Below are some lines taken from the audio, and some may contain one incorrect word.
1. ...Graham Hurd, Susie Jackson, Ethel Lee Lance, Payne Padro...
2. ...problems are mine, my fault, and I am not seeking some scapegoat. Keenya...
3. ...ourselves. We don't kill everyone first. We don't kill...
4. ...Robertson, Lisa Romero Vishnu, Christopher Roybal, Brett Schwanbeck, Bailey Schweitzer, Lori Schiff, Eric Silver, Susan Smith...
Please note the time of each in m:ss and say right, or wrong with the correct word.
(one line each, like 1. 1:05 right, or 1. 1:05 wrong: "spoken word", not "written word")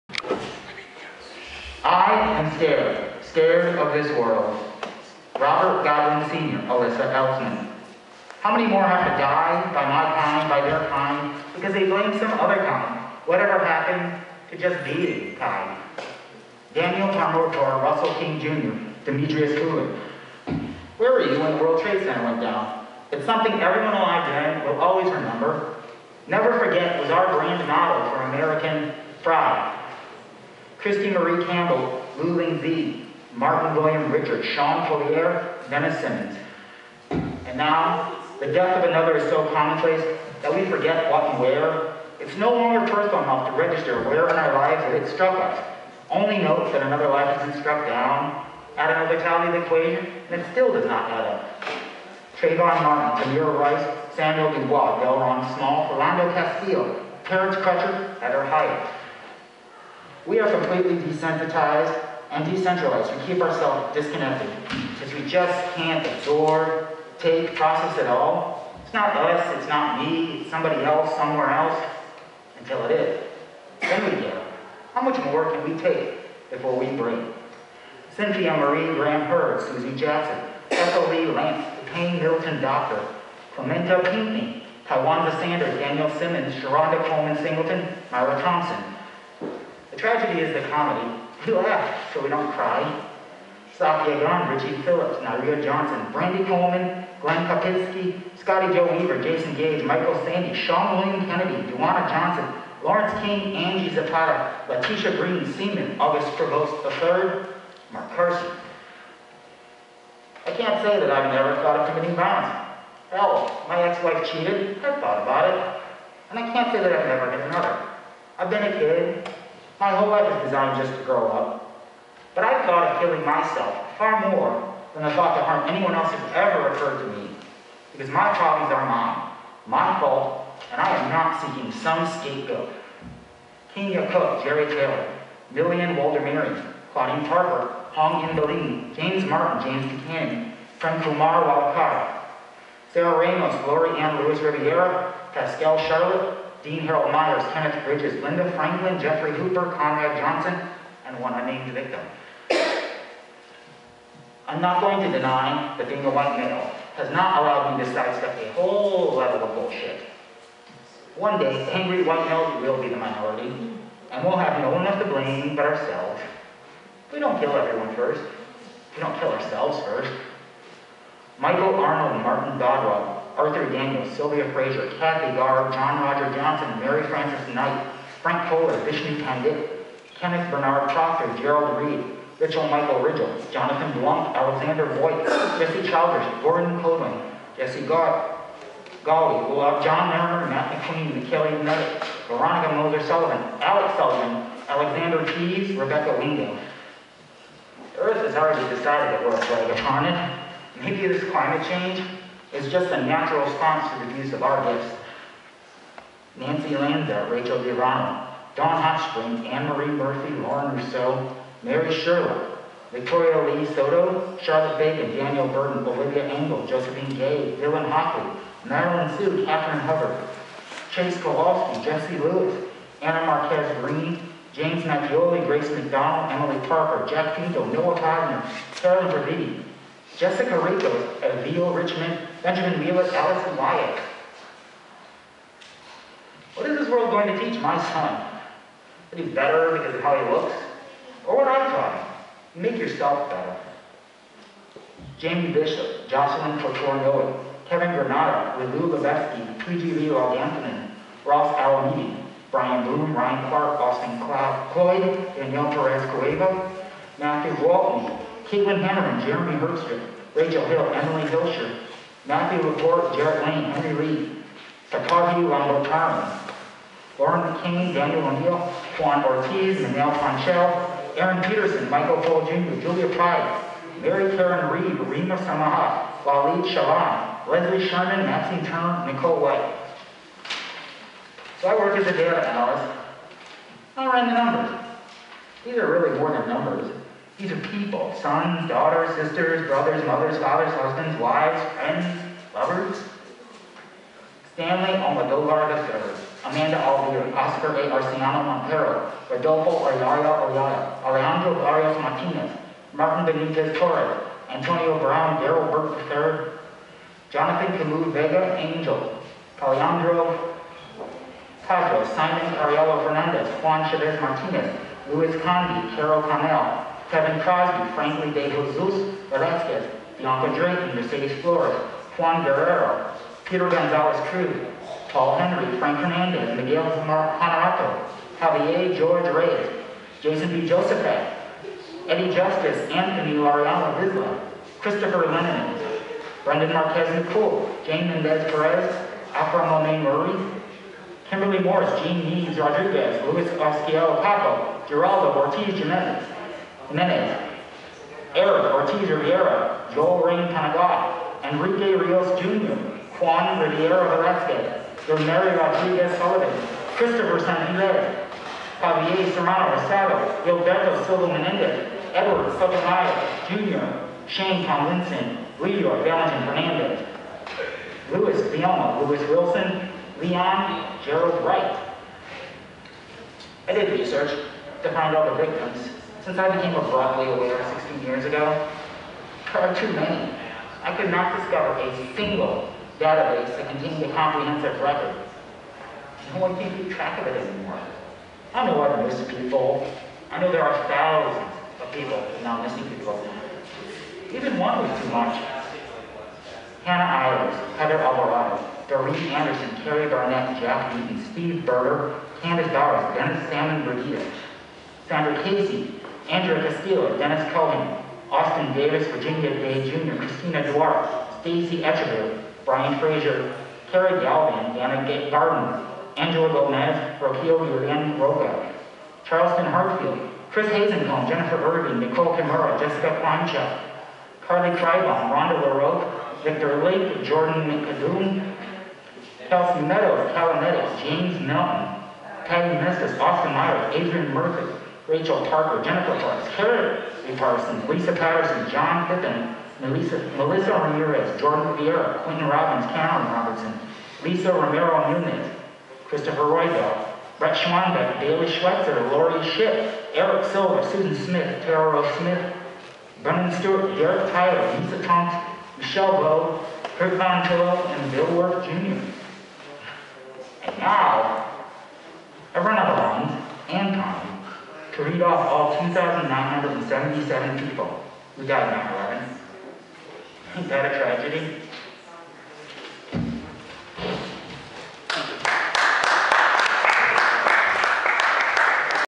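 1. 1:18 wrong: "Hilton", not "Padro"
2. 2:08 right
3. 2:45 right
4. 7:23 wrong: "Nunez", not "Vishnu".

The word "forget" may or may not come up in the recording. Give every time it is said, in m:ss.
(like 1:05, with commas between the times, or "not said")
0:26, 0:40.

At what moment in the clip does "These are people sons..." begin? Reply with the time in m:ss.
4:47.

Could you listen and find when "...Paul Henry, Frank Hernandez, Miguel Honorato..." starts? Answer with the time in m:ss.
5:25.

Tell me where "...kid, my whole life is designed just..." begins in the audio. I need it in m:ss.
1:58.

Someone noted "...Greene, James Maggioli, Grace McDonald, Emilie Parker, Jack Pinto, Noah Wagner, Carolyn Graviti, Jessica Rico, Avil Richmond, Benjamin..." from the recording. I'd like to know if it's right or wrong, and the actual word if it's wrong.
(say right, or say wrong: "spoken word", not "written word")
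right.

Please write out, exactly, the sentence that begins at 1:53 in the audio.
Hell, my ex-wife cheated, I thought about it.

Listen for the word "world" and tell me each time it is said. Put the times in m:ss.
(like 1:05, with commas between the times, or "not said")
0:04, 0:21, 3:56.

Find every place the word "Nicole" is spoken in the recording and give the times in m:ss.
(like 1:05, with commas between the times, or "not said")
4:39, 7:01.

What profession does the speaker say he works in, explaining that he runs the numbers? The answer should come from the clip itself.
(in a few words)
data analyst.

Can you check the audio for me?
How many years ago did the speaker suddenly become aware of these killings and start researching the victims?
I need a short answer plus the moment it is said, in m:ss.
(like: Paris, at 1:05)
16, at 6:17.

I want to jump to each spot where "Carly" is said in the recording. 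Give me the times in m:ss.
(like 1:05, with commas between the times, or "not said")
7:04.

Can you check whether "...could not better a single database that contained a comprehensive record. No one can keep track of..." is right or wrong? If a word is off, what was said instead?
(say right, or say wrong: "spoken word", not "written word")
wrong: "discover", not "better".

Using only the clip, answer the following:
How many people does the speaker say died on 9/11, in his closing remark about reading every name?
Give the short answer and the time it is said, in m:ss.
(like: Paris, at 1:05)
2,977, at 7:45.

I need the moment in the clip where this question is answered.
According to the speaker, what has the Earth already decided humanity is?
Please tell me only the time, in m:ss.
3:19.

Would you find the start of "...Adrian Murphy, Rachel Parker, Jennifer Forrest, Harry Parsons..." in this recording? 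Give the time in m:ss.
7:13.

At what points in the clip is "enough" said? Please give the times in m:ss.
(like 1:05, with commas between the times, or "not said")
0:43.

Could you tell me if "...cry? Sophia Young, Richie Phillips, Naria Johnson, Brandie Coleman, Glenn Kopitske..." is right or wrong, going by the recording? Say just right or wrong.
right.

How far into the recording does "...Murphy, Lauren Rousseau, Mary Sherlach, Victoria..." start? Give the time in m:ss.
3:29.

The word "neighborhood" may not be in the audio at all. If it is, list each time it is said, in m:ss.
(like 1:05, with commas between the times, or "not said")
not said.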